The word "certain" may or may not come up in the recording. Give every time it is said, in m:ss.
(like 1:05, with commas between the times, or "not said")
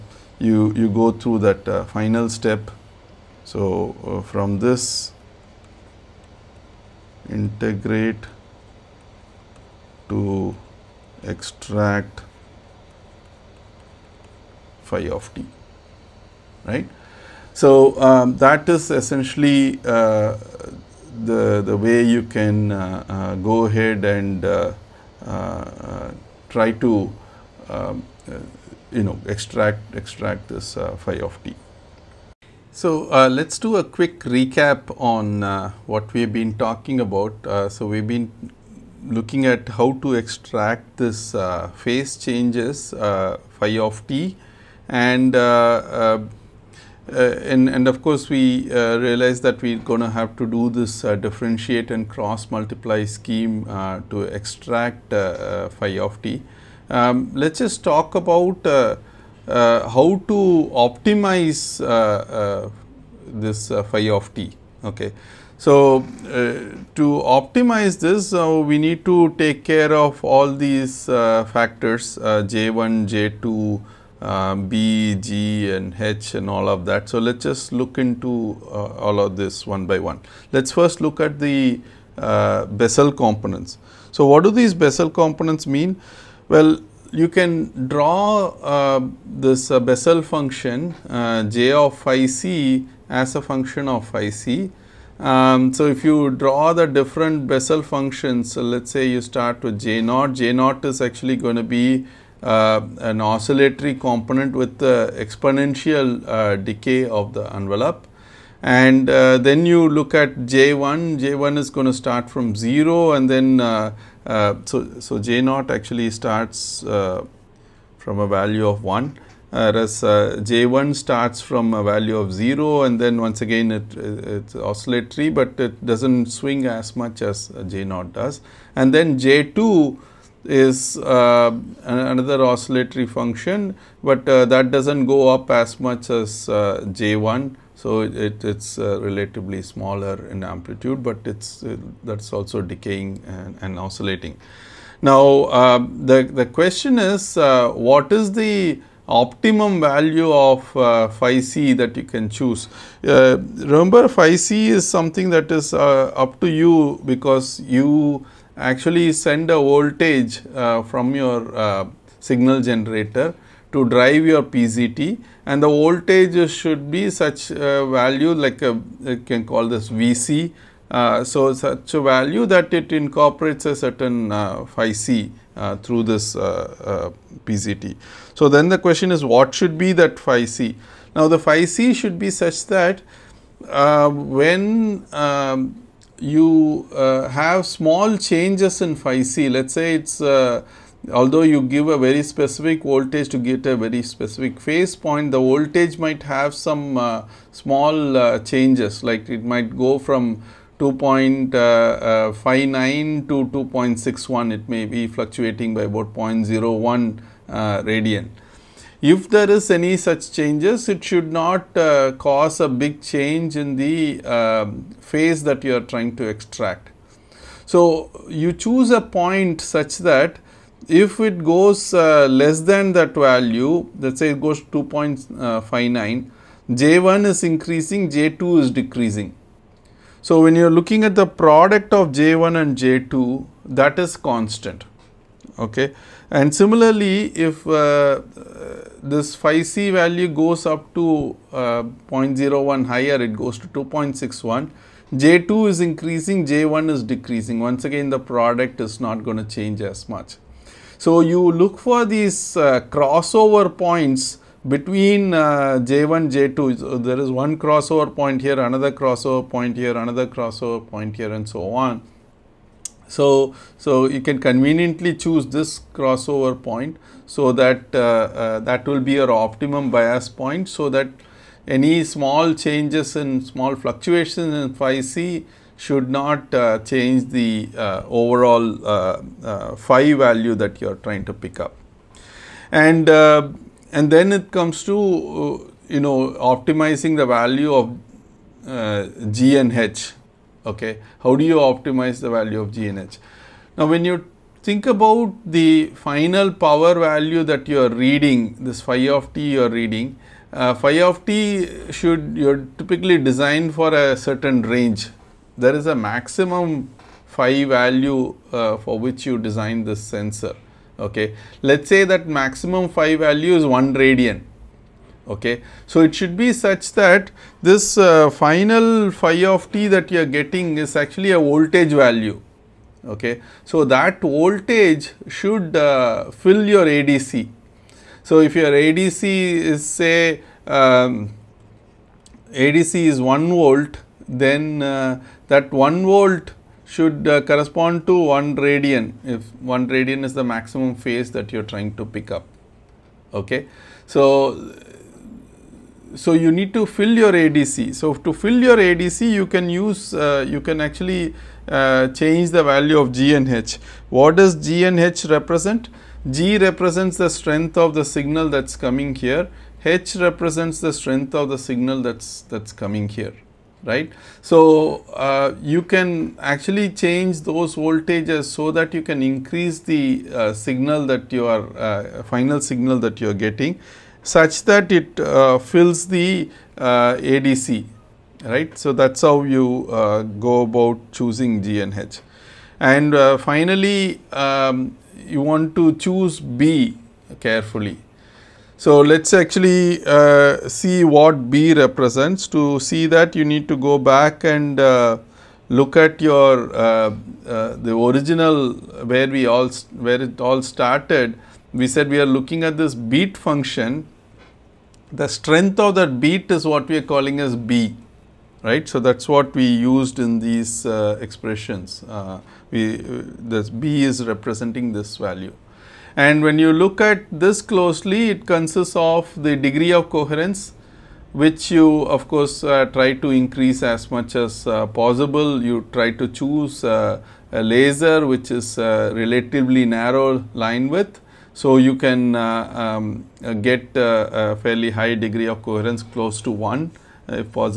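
2:53, 5:04.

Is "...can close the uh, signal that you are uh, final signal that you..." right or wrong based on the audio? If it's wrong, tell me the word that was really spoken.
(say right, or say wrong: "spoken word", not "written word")
wrong: "increase", not "close".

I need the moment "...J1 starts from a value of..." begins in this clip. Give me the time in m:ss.
2:00.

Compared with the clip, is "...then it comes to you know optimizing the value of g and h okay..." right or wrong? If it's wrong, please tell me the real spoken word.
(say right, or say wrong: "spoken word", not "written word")
right.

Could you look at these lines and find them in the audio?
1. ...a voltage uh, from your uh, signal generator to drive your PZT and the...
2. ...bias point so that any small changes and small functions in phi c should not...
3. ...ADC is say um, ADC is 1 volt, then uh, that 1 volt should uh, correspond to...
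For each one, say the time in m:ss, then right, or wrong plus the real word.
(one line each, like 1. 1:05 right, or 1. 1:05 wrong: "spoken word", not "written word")
1. 2:39 right
2. 4:29 wrong: "fluctuations", not "functions"
3. 5:28 right.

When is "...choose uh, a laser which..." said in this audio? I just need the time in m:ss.
7:06.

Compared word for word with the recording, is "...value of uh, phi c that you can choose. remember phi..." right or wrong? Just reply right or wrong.
right.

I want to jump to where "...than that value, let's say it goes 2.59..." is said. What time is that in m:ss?
3:42.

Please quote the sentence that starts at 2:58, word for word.
So, then the question is what should be that phi C?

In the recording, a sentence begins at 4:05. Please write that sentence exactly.
J2 is increasing, J1 is decreasing.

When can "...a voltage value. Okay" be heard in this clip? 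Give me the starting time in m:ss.
5:21.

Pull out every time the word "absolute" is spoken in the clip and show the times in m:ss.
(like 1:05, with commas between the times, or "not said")
not said.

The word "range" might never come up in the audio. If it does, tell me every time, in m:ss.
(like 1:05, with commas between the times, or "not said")
5:04.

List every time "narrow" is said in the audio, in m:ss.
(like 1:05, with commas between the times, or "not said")
7:09.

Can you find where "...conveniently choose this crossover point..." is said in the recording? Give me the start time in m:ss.
4:24.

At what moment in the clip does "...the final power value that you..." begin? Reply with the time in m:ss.
4:55.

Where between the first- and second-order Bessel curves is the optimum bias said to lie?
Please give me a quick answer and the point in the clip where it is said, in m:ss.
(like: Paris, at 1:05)
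crossover points, at 4:12.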